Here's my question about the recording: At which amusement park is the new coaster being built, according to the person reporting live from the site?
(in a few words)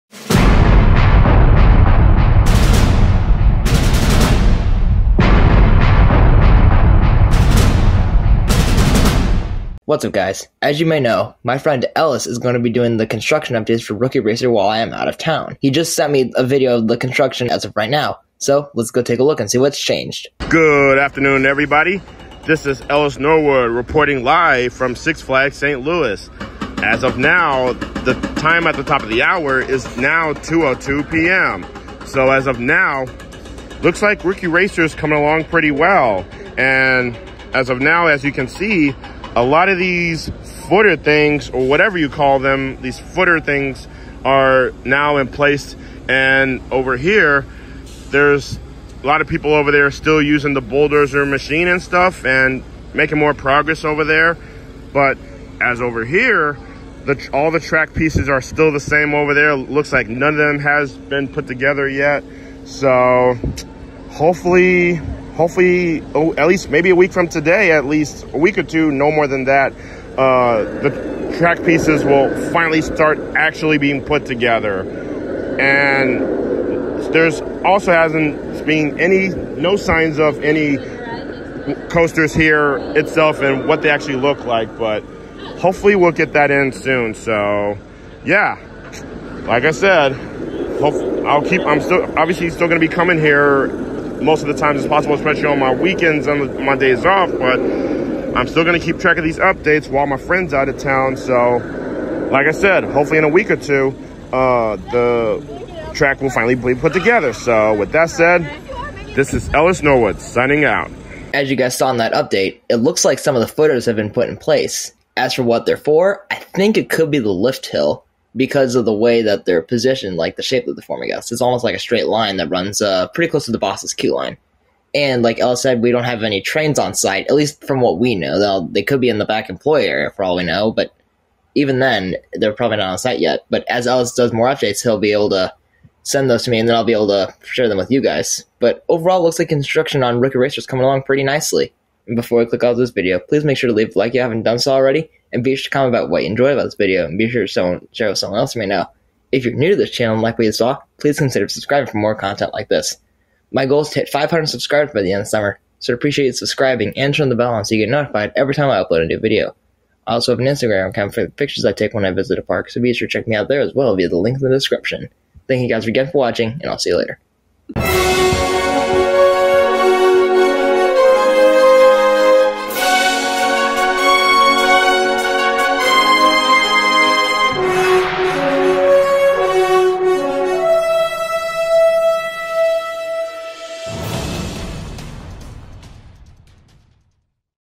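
Six Flags St. Louis.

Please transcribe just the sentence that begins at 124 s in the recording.
And like Ella said, we don't have any trains on site, at least from what we know.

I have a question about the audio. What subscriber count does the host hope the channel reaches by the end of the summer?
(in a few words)
500.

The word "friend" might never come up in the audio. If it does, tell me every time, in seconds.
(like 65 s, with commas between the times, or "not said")
11 s, 100 s.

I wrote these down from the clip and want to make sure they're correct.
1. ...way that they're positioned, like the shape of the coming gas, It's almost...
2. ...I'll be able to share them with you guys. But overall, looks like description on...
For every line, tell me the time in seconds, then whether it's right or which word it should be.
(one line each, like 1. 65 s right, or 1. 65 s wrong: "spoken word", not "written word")
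1. 118 s wrong: "forming", not "coming"
2. 136 s wrong: "construction", not "description".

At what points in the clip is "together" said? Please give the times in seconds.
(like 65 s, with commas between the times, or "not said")
61 s, 74 s, 106 s.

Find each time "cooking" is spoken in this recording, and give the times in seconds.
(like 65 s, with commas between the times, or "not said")
not said.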